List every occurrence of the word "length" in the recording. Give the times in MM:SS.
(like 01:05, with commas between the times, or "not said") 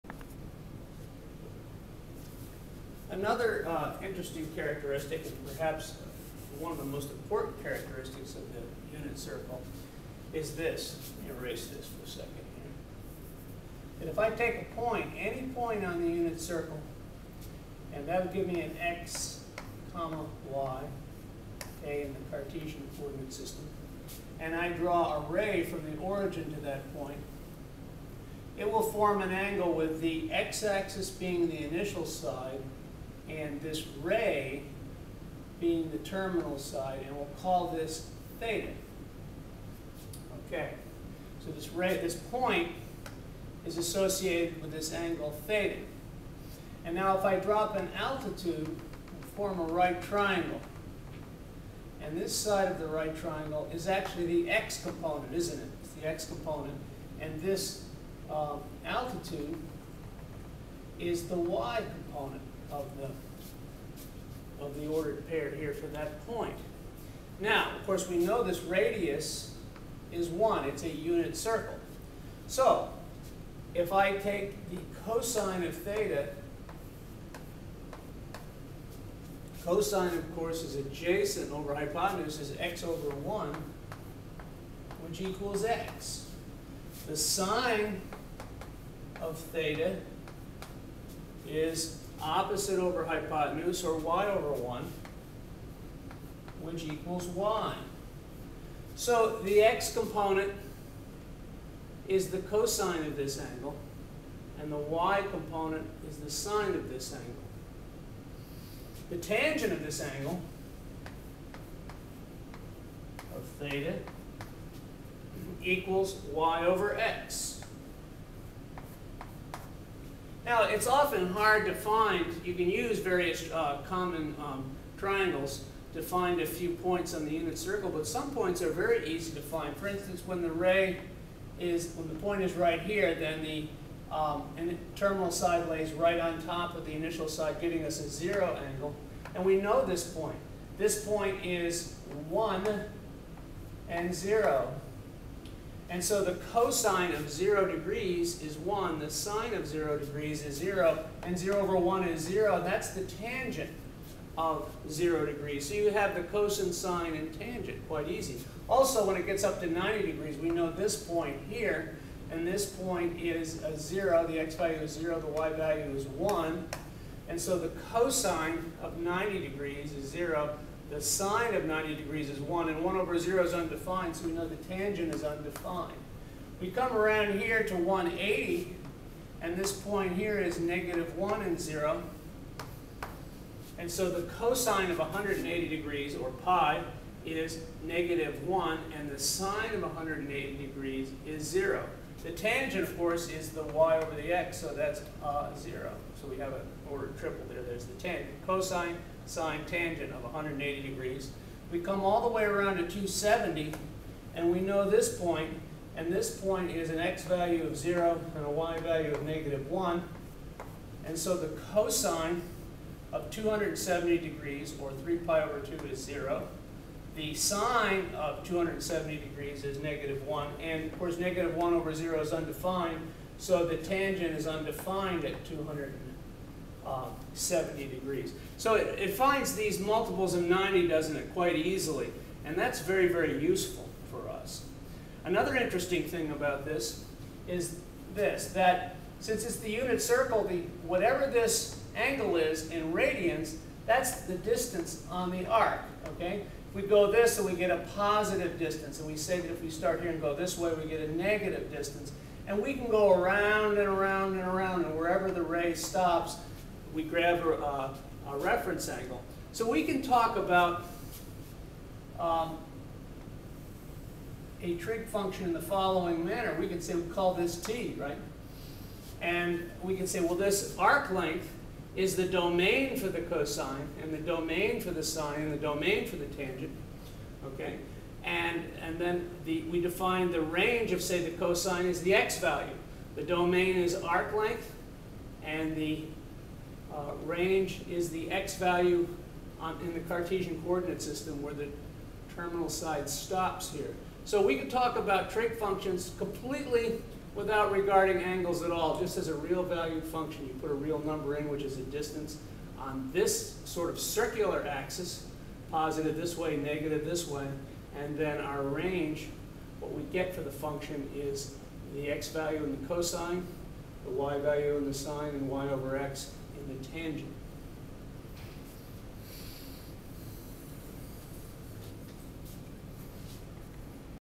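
04:31, 04:44.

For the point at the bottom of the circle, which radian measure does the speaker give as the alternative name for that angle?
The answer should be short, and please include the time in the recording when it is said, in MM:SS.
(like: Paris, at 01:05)
3 pi over 2, at 03:35.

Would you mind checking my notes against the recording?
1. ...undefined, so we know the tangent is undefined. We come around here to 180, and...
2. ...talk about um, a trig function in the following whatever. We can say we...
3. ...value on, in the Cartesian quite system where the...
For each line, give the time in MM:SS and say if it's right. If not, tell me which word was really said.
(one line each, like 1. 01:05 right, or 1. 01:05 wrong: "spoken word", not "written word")
1. 02:53 right
2. 04:20 wrong: "manner", not "whatever"
3. 04:48 wrong: "coordinate", not "quite".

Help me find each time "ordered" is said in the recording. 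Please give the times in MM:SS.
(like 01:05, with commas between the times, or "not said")
01:04, 03:16.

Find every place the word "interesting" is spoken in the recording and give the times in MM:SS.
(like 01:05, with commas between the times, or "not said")
00:04, 03:55.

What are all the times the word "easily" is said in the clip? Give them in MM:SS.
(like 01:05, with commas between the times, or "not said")
03:51.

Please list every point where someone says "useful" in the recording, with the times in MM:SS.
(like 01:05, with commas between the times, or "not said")
03:53.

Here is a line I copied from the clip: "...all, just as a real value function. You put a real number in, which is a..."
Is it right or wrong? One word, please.
right.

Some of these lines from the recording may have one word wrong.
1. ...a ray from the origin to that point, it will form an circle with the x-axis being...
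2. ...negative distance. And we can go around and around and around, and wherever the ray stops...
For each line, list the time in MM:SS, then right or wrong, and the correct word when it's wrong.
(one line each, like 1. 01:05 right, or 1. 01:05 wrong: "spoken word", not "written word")
1. 00:25 wrong: "angle", not "circle"
2. 04:11 right.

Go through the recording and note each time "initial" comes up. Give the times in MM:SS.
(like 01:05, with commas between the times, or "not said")
00:31, 02:16.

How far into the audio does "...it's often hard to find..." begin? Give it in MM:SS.
02:00.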